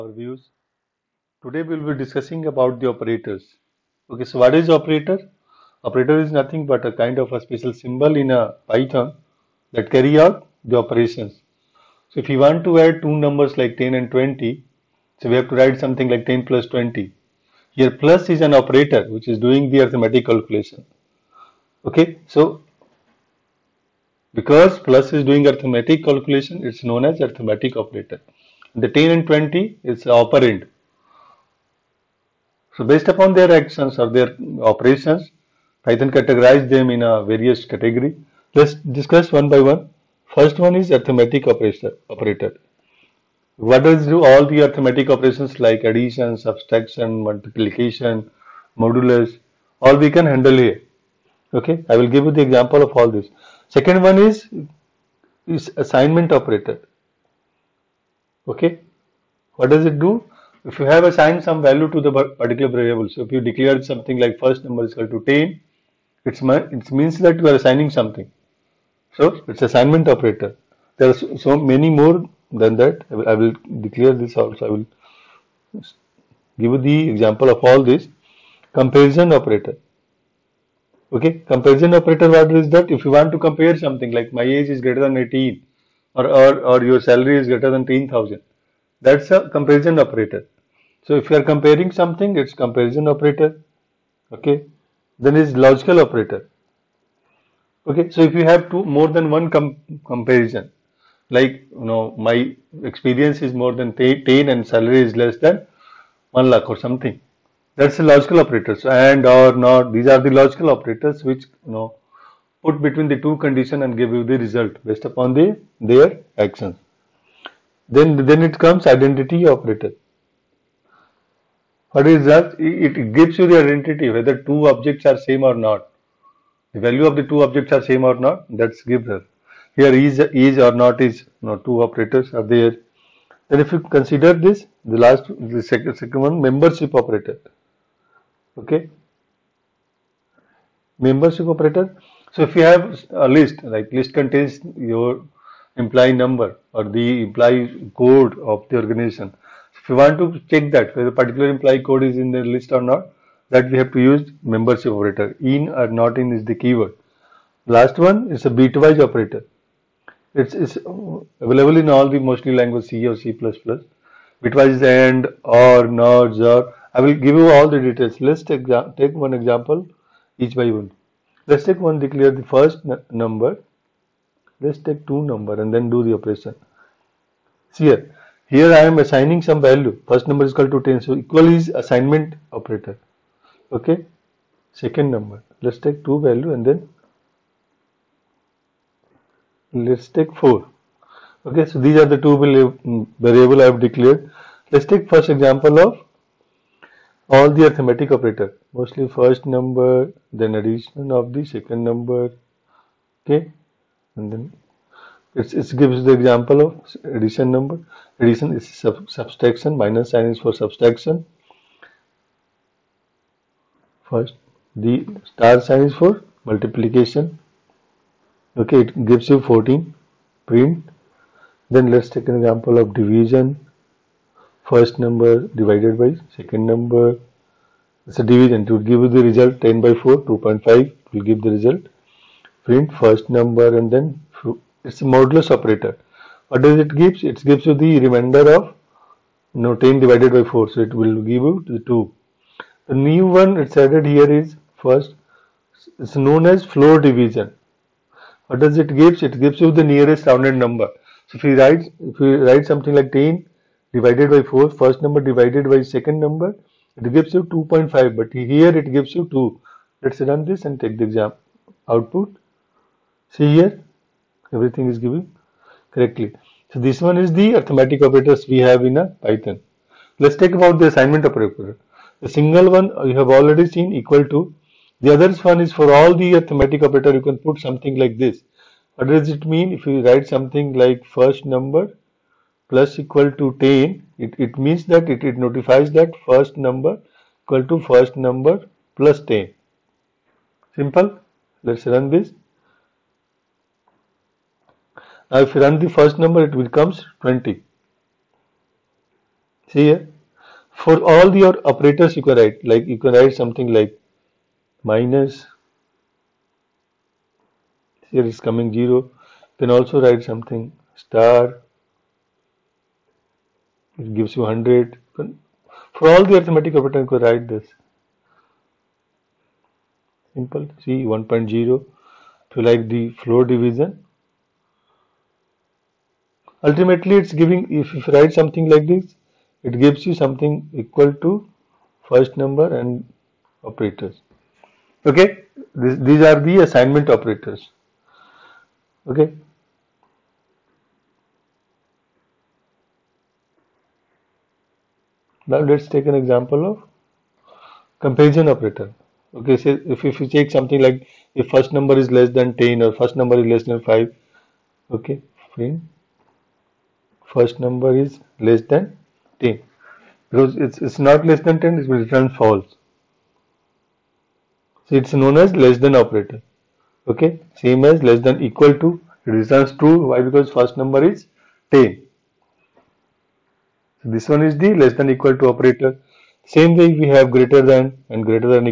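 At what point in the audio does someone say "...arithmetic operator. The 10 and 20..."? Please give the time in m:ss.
0:27.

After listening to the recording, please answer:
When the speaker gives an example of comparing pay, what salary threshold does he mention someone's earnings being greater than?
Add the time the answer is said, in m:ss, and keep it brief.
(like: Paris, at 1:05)
10,000, at 1:27.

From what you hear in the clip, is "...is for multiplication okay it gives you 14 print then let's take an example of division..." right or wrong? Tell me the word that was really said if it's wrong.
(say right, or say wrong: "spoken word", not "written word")
right.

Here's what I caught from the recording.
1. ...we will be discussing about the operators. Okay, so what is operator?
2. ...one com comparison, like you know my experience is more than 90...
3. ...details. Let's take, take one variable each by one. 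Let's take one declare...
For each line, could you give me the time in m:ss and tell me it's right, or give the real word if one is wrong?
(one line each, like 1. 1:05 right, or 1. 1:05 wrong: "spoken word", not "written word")
1. 0:01 right
2. 1:39 wrong: "10", not "90"
3. 2:47 wrong: "example", not "variable".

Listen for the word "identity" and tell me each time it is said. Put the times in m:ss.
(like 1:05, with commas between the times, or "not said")
1:58, 2:03.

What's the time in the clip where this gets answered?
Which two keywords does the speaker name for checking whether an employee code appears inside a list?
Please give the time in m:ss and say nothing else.
2:35.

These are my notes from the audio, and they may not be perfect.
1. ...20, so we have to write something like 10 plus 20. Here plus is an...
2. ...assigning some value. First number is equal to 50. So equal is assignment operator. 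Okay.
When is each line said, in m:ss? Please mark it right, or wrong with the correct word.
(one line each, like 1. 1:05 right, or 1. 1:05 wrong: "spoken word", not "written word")
1. 0:14 right
2. 2:58 wrong: "10", not "50".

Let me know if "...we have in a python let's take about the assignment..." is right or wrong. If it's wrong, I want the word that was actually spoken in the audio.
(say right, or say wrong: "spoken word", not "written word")
right.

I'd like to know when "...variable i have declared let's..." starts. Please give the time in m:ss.
3:13.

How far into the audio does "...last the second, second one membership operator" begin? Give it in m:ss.
2:14.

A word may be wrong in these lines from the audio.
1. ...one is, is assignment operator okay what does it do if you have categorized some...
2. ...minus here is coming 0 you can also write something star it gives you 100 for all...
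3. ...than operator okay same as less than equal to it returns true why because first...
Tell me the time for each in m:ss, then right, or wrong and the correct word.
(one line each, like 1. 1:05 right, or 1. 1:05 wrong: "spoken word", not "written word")
1. 0:54 wrong: "assigned", not "categorized"
2. 5:04 right
3. 6:05 right.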